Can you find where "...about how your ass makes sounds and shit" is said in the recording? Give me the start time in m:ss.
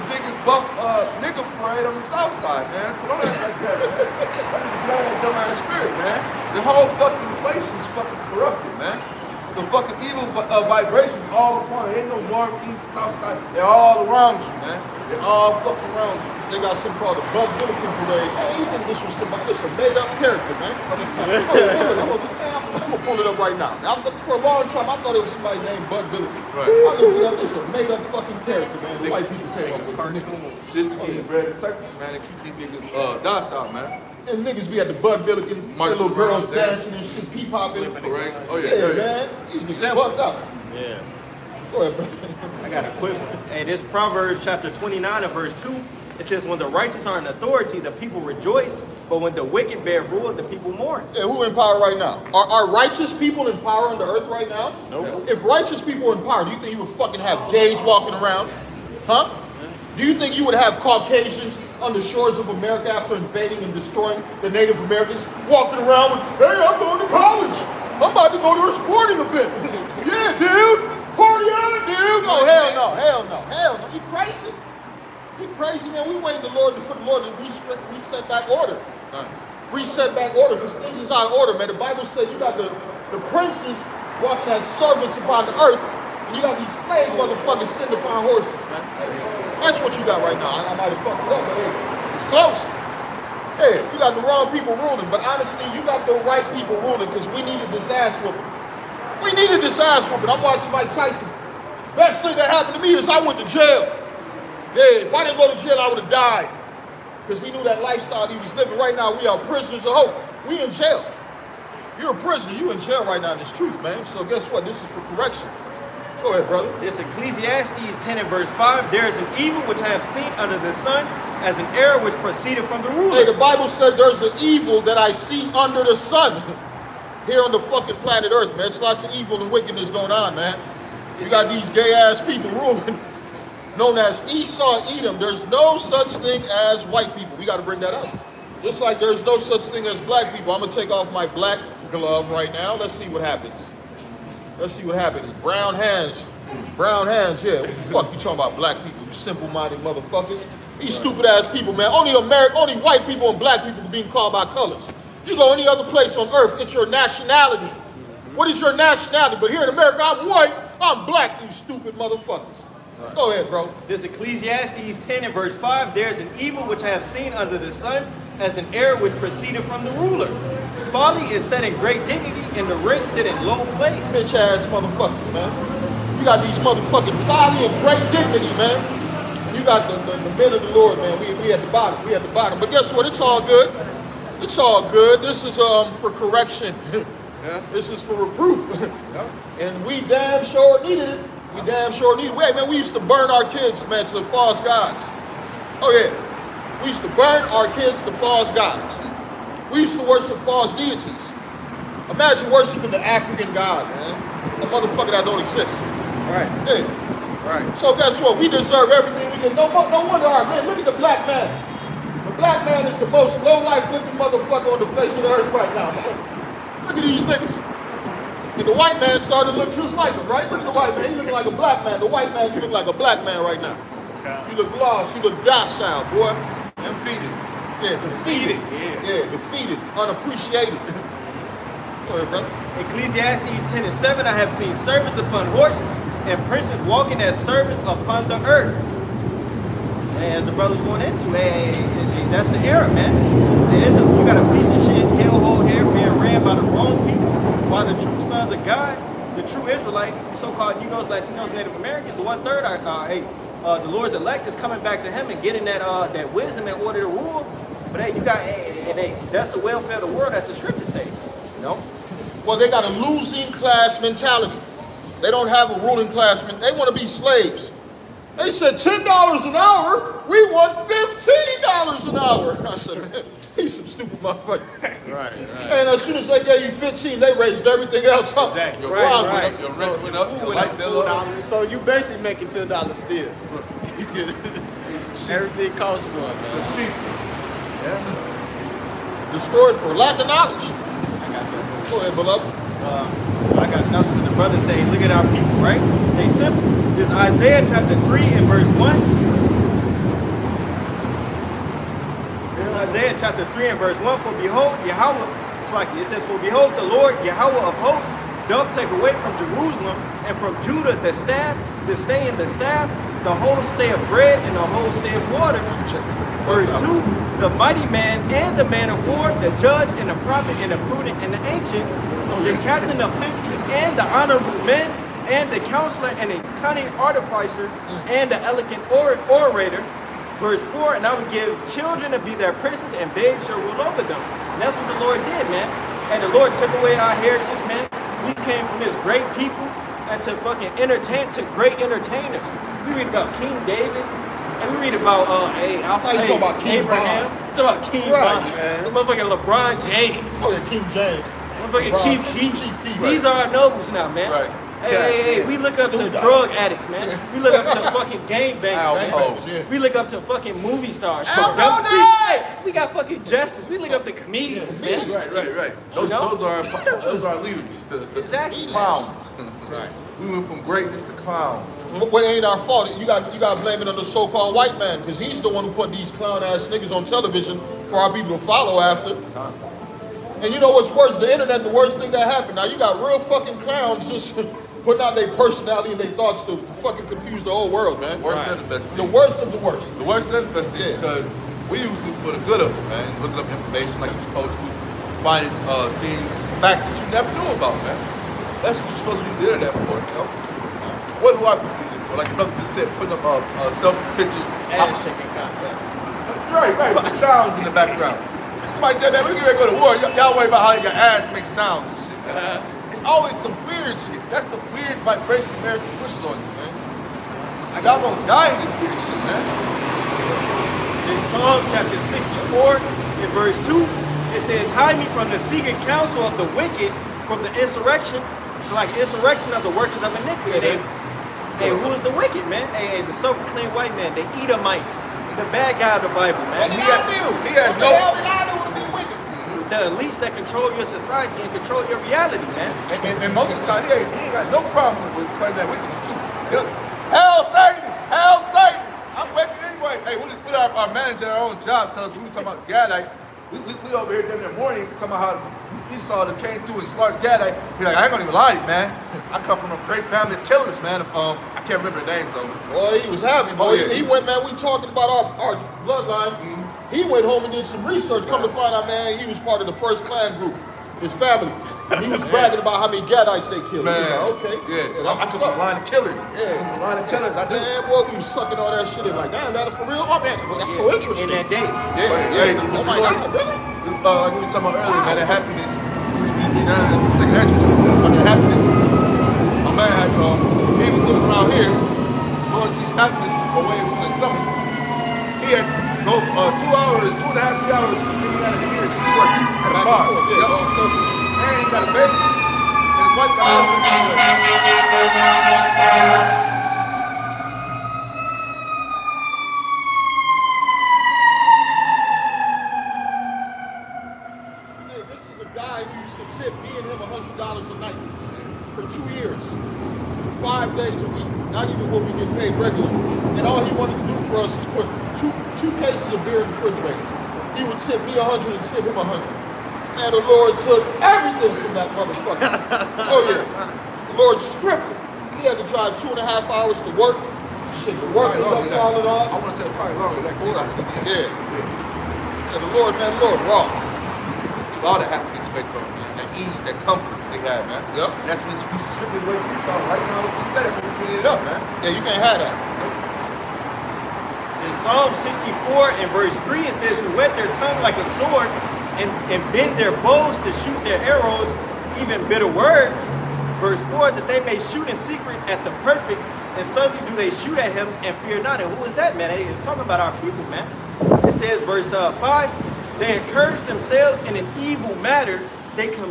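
6:50.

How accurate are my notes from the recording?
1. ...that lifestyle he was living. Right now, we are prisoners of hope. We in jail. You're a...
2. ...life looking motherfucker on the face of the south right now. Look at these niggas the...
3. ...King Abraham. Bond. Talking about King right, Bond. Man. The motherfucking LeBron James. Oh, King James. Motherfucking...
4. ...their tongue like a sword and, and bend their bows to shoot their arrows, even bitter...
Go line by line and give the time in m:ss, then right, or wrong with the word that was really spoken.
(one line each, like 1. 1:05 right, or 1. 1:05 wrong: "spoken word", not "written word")
1. 1:47 right
2. 3:33 wrong: "earth", not "south"
3. 5:46 right
4. 9:17 right.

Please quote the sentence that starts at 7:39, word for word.
I come from a great family of killers, man.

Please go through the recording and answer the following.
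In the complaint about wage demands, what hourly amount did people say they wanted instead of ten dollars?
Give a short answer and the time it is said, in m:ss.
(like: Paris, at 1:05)
$15, at 4:30.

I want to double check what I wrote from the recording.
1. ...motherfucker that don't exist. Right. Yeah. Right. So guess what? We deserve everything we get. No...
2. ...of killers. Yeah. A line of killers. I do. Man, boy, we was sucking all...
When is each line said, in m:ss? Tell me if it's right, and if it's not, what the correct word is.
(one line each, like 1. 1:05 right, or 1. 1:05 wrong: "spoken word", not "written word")
1. 3:24 right
2. 7:55 right.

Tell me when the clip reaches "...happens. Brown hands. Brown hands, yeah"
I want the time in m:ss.
2:24.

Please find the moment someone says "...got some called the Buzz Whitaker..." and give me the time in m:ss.
0:16.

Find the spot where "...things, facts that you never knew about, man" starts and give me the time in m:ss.
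6:35.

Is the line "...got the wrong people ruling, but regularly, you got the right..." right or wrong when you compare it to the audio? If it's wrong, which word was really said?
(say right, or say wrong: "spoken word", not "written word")
wrong: "honestly", not "regularly".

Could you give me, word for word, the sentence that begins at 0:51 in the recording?
And who in power right now?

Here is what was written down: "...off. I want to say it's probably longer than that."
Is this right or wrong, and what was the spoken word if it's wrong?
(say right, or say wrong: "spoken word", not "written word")
right.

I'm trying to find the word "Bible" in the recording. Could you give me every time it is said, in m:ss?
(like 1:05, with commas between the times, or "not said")
1:21, 2:03, 7:16.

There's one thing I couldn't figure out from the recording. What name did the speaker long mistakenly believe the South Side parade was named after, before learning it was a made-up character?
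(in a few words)
Buzz Billiken.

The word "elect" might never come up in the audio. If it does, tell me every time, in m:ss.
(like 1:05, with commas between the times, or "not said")
4:14.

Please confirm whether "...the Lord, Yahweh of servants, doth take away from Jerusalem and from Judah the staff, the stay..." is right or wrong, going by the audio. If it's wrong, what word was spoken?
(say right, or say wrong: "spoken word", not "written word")
wrong: "hosts", not "servants".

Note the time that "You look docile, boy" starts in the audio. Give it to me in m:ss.
3:45.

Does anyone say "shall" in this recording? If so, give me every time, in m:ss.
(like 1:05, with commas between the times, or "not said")
5:33.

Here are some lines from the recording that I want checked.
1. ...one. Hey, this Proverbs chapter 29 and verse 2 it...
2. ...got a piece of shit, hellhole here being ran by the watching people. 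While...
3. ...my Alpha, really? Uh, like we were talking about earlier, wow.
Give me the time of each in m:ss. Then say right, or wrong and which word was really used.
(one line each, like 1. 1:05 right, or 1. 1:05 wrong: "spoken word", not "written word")
1. 0:43 right
2. 4:04 wrong: "wrong", not "watching"
3. 8:02 wrong: "God", not "Alpha".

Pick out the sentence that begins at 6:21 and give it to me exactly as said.
The internet, the worst thing that happened.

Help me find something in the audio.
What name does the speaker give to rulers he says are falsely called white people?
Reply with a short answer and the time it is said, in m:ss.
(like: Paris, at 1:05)
Esau Edom, at 2:14.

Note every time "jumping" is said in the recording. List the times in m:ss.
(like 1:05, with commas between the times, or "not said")
not said.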